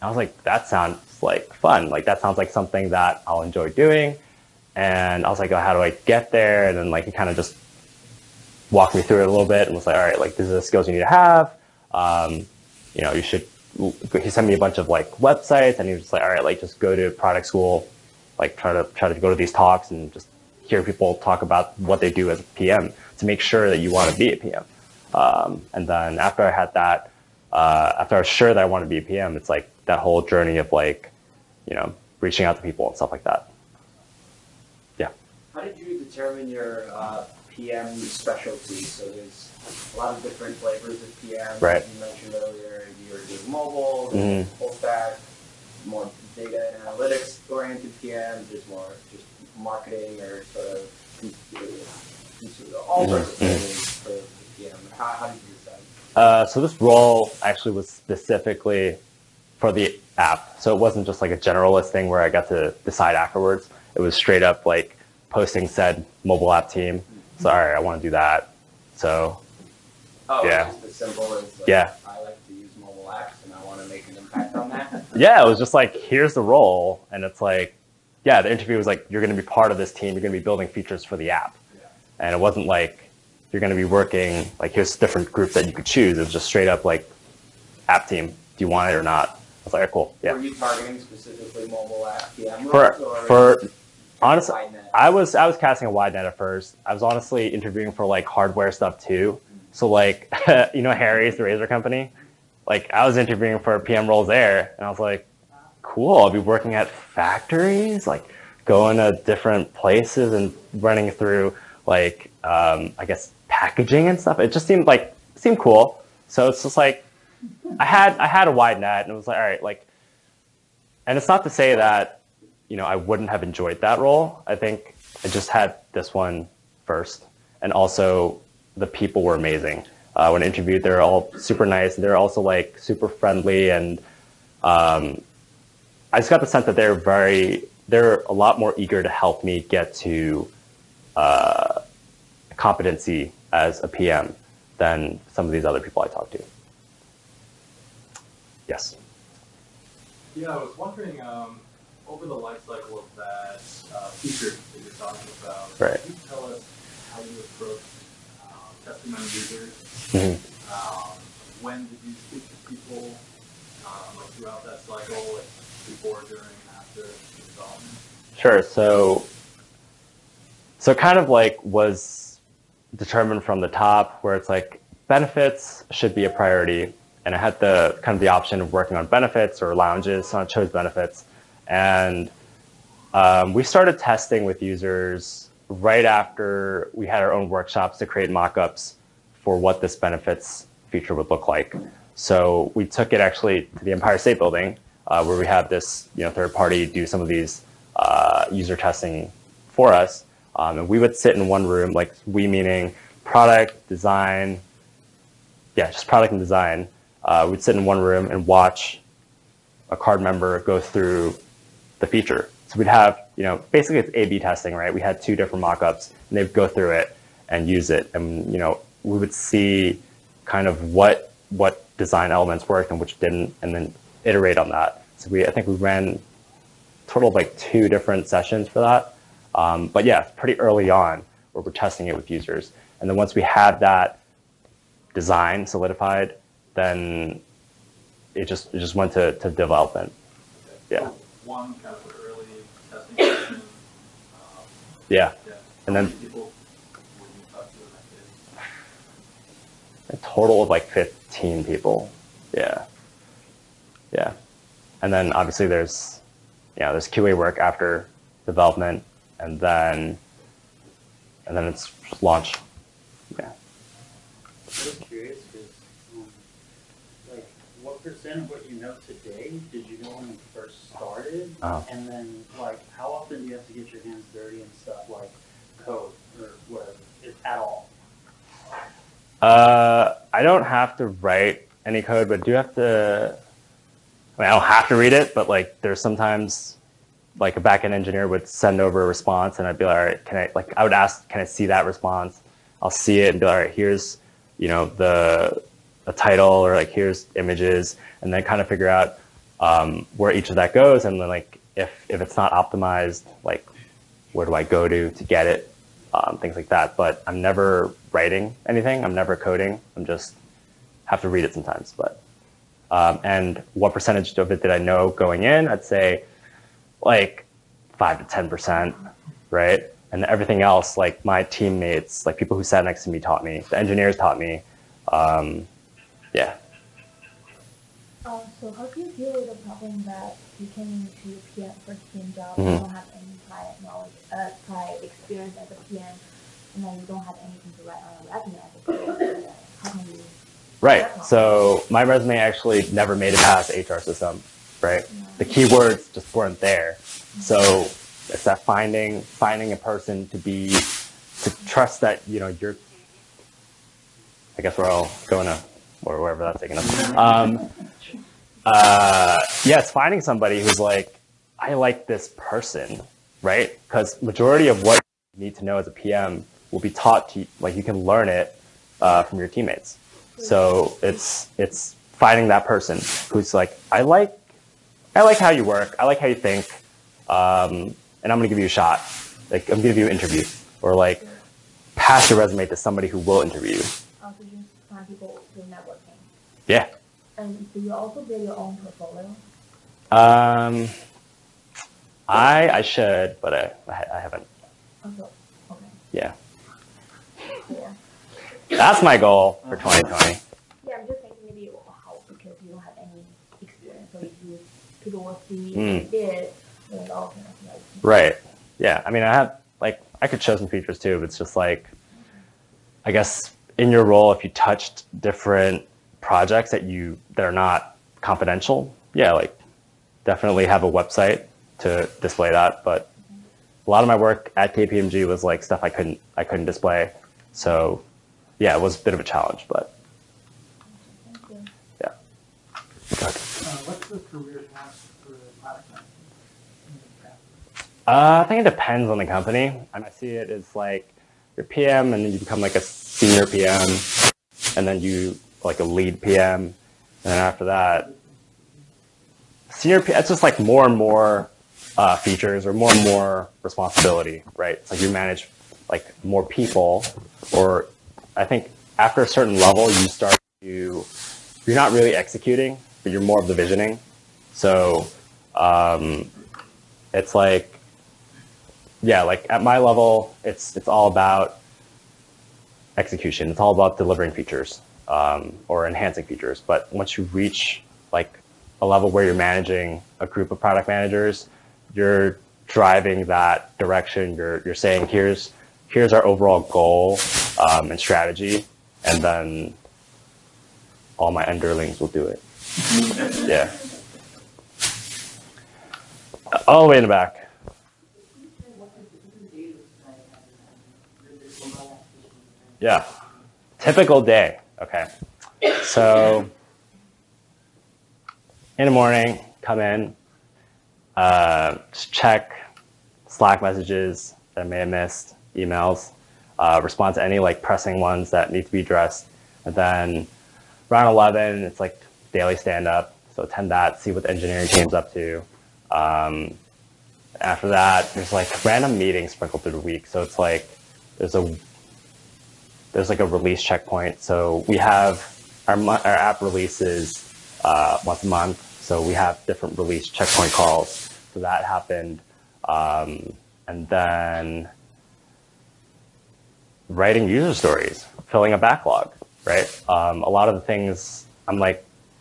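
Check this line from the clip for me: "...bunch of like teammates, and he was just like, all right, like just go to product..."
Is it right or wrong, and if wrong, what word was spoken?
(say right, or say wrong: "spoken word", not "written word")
wrong: "websites", not "teammates".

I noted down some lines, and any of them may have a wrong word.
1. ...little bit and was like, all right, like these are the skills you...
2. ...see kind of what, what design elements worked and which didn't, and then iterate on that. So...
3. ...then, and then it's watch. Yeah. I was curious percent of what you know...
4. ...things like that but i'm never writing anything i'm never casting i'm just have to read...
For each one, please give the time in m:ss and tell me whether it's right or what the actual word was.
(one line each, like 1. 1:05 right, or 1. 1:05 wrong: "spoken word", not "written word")
1. 0:09 right
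2. 3:39 right
3. 4:19 wrong: "launch", not "watch"
4. 5:06 wrong: "coding", not "casting".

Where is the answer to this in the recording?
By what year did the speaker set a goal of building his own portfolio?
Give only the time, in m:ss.
6:39.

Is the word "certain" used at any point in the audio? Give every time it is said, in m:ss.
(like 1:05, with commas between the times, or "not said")
7:39.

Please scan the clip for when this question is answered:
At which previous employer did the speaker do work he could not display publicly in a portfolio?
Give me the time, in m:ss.
7:04.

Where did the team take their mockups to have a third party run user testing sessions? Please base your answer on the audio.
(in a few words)
Empire State Building.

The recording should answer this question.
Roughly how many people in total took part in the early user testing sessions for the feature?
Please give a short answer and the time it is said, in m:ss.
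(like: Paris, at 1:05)
15, at 4:10.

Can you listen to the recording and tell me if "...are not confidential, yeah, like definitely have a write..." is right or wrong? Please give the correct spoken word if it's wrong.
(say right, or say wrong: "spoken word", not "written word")
wrong: "website", not "write".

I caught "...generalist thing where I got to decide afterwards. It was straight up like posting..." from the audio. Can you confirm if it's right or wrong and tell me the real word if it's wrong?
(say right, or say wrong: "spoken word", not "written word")
right.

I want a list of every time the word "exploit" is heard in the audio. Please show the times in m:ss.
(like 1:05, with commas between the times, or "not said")
not said.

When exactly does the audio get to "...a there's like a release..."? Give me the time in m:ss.
8:51.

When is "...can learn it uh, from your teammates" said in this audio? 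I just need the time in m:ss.
6:07.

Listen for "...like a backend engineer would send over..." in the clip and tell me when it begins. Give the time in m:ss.
4:47.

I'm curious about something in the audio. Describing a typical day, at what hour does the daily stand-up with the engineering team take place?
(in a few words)
11.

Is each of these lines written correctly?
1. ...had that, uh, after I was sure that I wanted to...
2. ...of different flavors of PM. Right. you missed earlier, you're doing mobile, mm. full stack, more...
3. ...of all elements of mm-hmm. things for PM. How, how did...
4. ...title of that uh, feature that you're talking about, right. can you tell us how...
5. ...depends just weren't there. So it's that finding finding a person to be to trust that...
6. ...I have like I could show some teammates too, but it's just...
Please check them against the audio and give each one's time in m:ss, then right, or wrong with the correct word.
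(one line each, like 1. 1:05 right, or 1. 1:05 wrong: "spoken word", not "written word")
1. 0:26 right
2. 0:40 wrong: "mentioned", not "missed"
3. 0:50 wrong: "sorts", not "elements"
4. 2:32 wrong: "cycle", not "title"
5. 5:45 wrong: "keywords", not "depends"
6. 6:49 wrong: "features", not "teammates".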